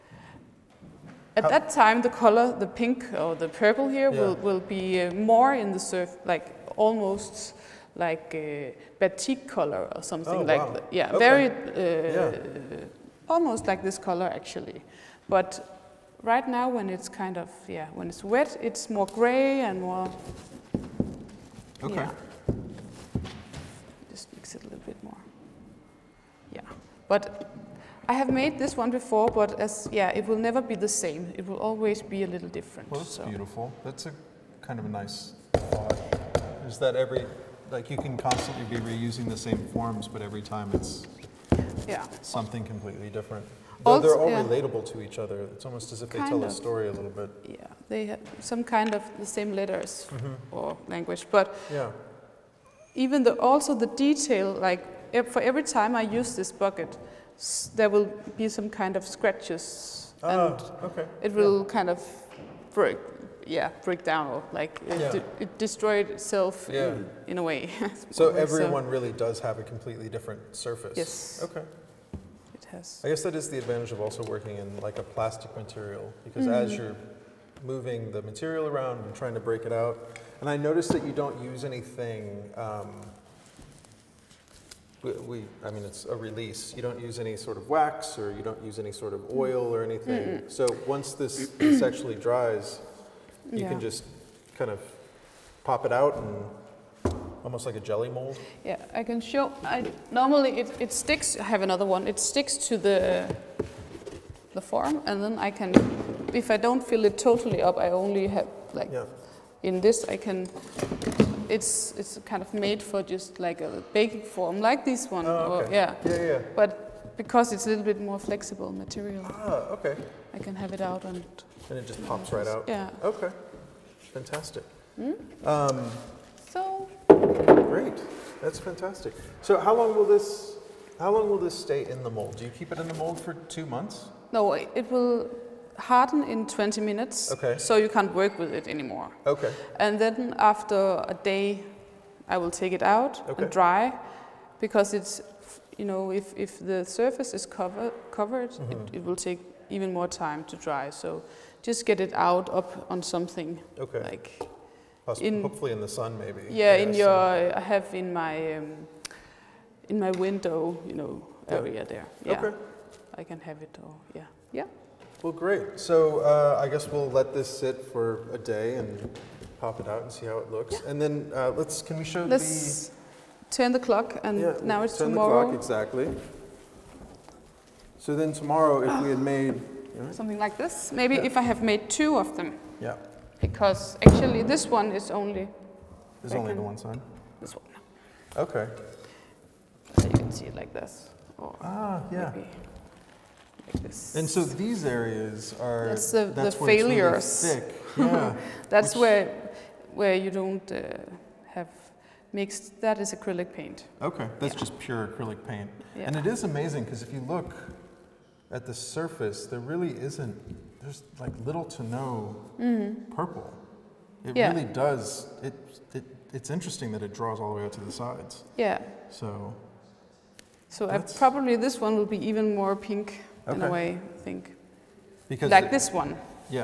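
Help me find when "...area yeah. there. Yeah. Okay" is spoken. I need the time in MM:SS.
02:41.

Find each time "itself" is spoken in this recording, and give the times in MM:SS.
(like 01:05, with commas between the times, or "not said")
01:06.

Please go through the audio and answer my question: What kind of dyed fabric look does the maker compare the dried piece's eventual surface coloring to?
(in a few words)
batik.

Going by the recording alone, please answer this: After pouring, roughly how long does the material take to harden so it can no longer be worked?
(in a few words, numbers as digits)
20 minutes.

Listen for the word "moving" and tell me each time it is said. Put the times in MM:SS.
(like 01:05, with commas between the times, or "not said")
01:17.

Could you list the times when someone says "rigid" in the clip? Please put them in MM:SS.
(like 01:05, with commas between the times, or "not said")
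not said.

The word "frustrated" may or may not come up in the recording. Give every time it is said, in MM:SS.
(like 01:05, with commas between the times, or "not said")
not said.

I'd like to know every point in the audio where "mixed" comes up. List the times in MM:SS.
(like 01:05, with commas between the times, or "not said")
03:22.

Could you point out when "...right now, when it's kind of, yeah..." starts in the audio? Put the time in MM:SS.
00:16.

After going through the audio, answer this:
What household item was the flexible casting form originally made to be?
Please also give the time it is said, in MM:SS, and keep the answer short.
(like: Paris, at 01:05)
baking form, at 01:53.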